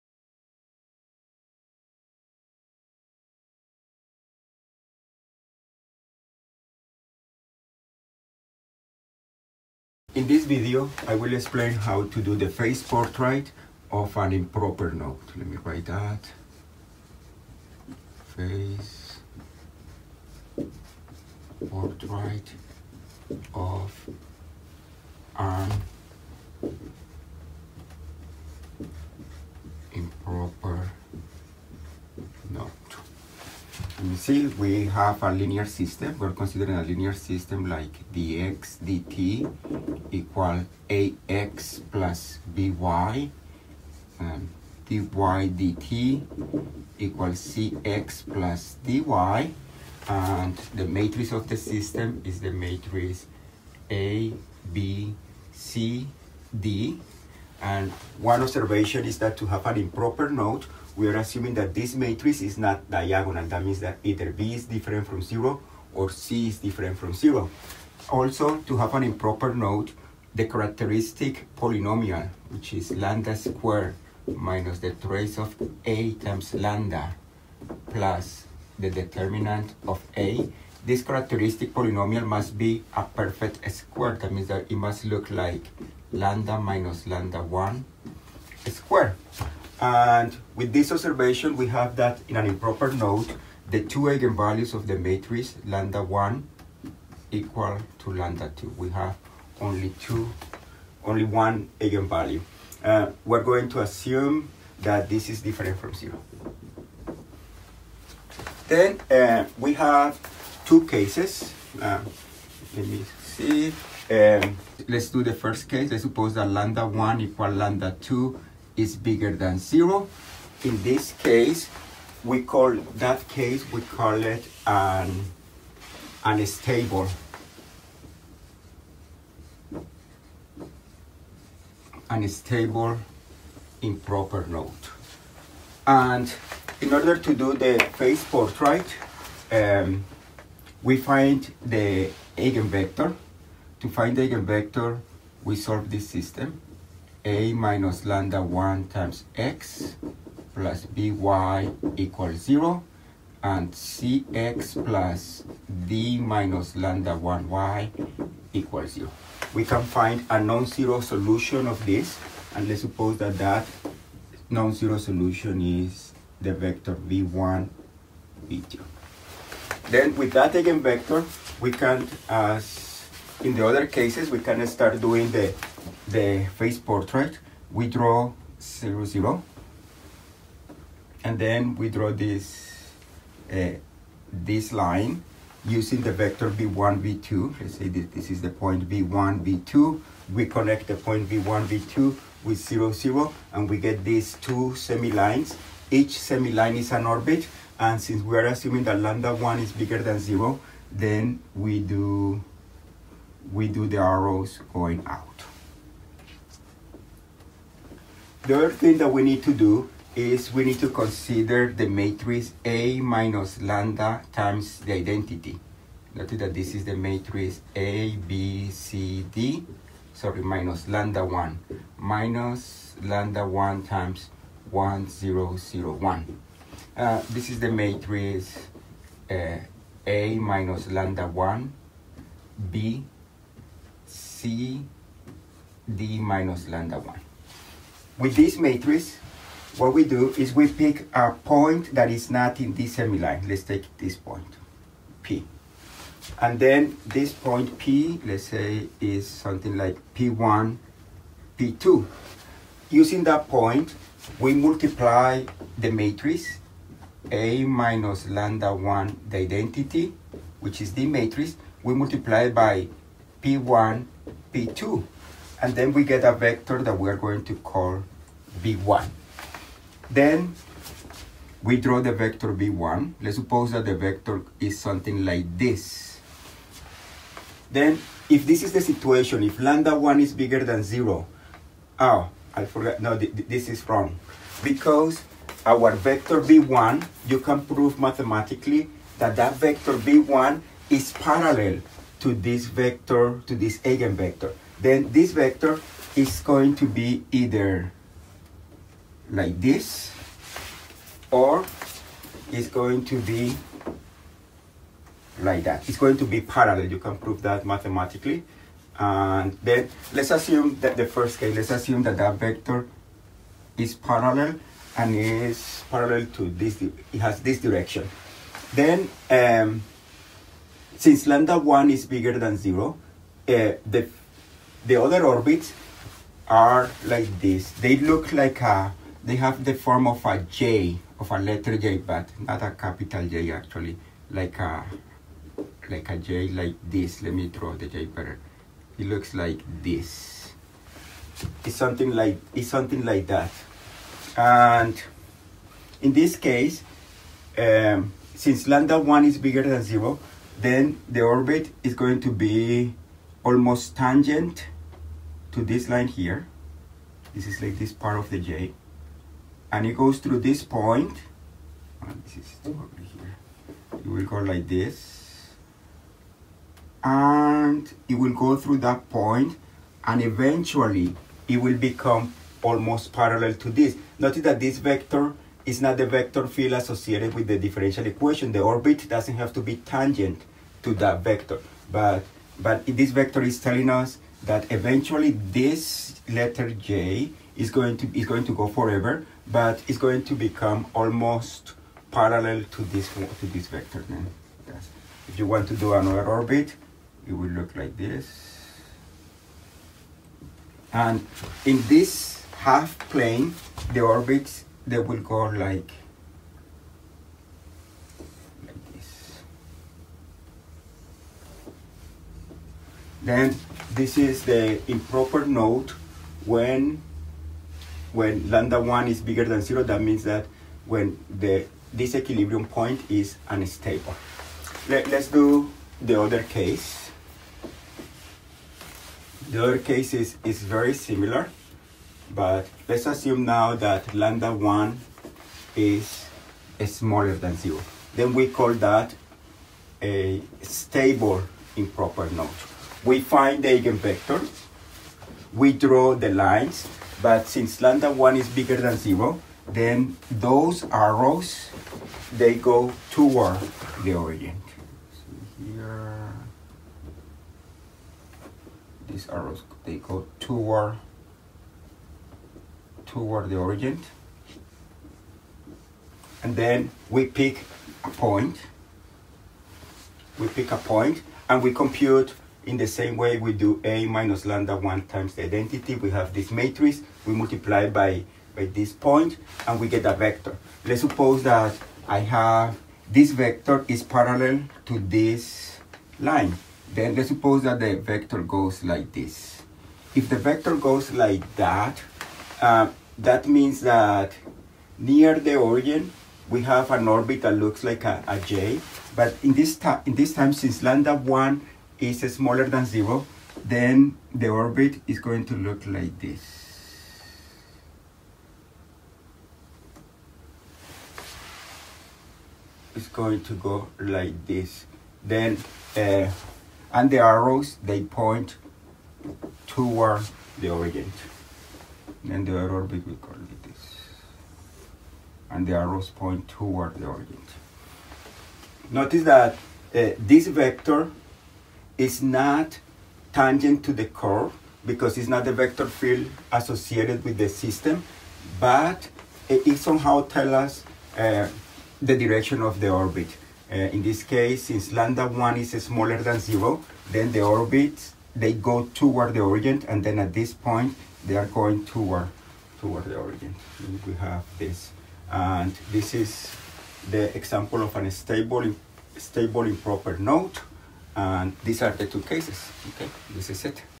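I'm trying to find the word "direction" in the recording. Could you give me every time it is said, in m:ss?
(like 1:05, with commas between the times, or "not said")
5:17, 9:02.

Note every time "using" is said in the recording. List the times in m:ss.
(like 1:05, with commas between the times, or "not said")
3:05, 4:12.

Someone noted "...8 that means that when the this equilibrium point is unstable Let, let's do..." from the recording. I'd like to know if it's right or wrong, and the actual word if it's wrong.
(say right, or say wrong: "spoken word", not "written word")
wrong: "0", not "8".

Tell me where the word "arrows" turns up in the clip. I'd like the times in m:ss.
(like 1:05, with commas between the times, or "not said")
3:23, 7:30, 7:39, 8:37, 8:45.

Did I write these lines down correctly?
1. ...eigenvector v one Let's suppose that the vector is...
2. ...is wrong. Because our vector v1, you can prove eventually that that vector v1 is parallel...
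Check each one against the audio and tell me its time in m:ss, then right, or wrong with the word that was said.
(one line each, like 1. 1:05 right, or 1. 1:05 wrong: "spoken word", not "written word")
1. 4:32 wrong: "vector", not "eigenvector"
2. 4:43 wrong: "mathematically", not "eventually".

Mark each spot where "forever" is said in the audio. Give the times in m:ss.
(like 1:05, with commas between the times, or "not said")
6:28.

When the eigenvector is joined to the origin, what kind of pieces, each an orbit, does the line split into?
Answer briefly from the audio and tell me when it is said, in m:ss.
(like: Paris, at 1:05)
Semi-lines, at 3:15.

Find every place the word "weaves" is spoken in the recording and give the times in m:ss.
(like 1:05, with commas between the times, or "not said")
not said.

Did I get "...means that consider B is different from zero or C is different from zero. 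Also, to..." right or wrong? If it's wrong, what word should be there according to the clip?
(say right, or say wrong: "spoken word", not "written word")
wrong: "either", not "consider".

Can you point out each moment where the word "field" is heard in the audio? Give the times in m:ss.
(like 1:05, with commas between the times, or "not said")
6:16, 8:55.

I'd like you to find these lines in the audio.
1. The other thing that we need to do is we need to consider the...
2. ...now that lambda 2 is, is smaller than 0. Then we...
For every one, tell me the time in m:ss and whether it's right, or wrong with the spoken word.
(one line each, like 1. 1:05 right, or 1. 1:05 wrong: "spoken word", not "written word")
1. 3:28 right
2. 7:13 wrong: "1", not "2".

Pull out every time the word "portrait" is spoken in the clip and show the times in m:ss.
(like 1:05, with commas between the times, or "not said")
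0:12, 0:21, 2:18, 2:56.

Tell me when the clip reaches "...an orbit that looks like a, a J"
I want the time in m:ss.
8:16.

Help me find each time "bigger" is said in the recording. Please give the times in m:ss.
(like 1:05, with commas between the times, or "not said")
1:58, 3:19, 4:40, 5:22, 5:49, 6:59, 7:28.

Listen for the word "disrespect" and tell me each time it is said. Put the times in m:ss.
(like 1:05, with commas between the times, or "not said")
not said.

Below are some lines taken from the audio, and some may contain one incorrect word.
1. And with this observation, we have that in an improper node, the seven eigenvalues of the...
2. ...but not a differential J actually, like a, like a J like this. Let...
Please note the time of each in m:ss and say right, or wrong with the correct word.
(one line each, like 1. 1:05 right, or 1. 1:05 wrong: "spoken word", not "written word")
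1. 1:29 wrong: "two", not "seven"
2. 5:31 wrong: "capital", not "differential".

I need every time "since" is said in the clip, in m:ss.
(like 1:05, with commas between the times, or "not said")
3:17, 5:20, 5:48, 7:27, 8:20, 9:04.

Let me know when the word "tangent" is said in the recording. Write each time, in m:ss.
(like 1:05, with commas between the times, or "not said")
5:53, 6:19, 8:53.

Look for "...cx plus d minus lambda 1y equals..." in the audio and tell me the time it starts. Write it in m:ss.
2:33.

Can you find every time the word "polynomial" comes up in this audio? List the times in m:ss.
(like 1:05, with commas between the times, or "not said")
1:11, 1:21.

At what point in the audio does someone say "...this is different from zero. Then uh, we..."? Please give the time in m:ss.
1:45.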